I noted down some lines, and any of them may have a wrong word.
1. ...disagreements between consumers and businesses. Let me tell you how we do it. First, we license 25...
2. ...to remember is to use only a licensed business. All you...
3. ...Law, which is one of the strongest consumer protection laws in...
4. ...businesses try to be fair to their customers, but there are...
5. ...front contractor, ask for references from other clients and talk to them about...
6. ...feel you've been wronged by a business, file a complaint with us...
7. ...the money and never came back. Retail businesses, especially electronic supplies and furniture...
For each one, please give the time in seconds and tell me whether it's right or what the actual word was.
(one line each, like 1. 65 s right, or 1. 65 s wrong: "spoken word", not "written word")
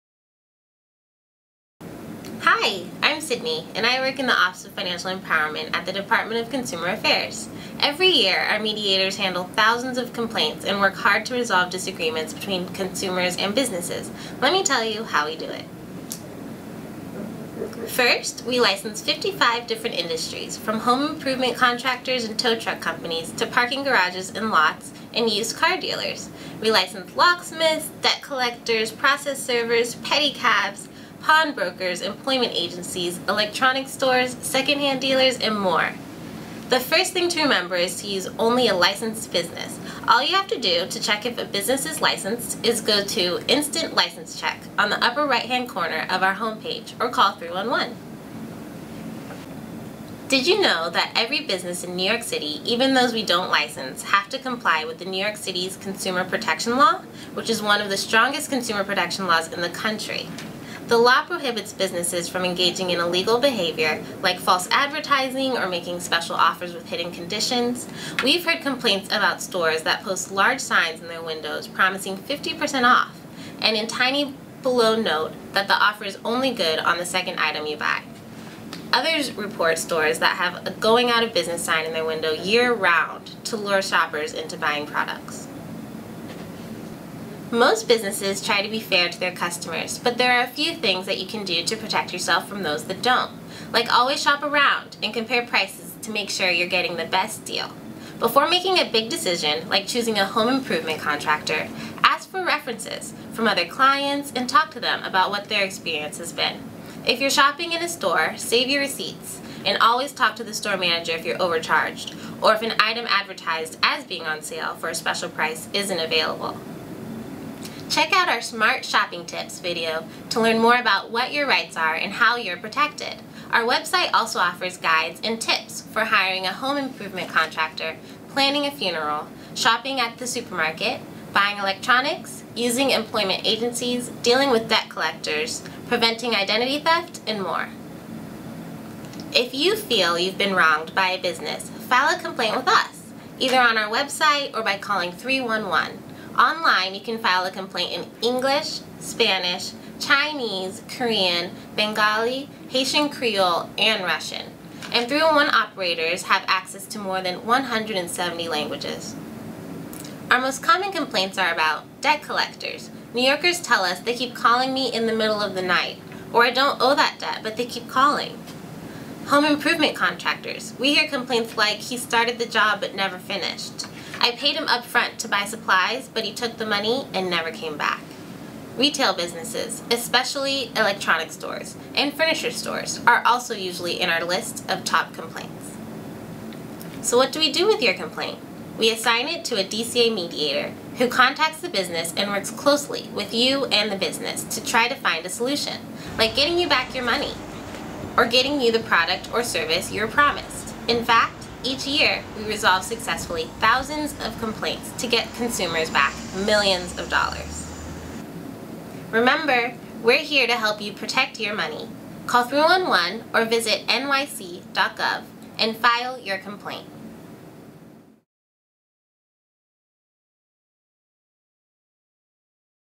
1. 11 s wrong: "55", not "25"
2. 37 s right
3. 56 s right
4. 87 s right
5. 100 s wrong: "improvement", not "front"
6. 139 s right
7. 176 s wrong: "stores", not "supplies".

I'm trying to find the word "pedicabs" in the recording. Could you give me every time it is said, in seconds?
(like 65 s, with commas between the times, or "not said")
29 s.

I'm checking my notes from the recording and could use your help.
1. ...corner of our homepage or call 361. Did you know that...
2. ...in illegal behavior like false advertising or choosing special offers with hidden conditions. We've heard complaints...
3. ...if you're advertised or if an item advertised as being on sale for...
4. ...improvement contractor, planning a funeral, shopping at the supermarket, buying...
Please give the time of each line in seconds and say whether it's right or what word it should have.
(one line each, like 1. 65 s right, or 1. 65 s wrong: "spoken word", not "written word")
1. 45 s wrong: "311", not "361"
2. 62 s wrong: "making", not "choosing"
3. 111 s wrong: "overcharged", not "advertised"
4. 126 s right.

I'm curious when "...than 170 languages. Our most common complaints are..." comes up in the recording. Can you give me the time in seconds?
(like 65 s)
157 s.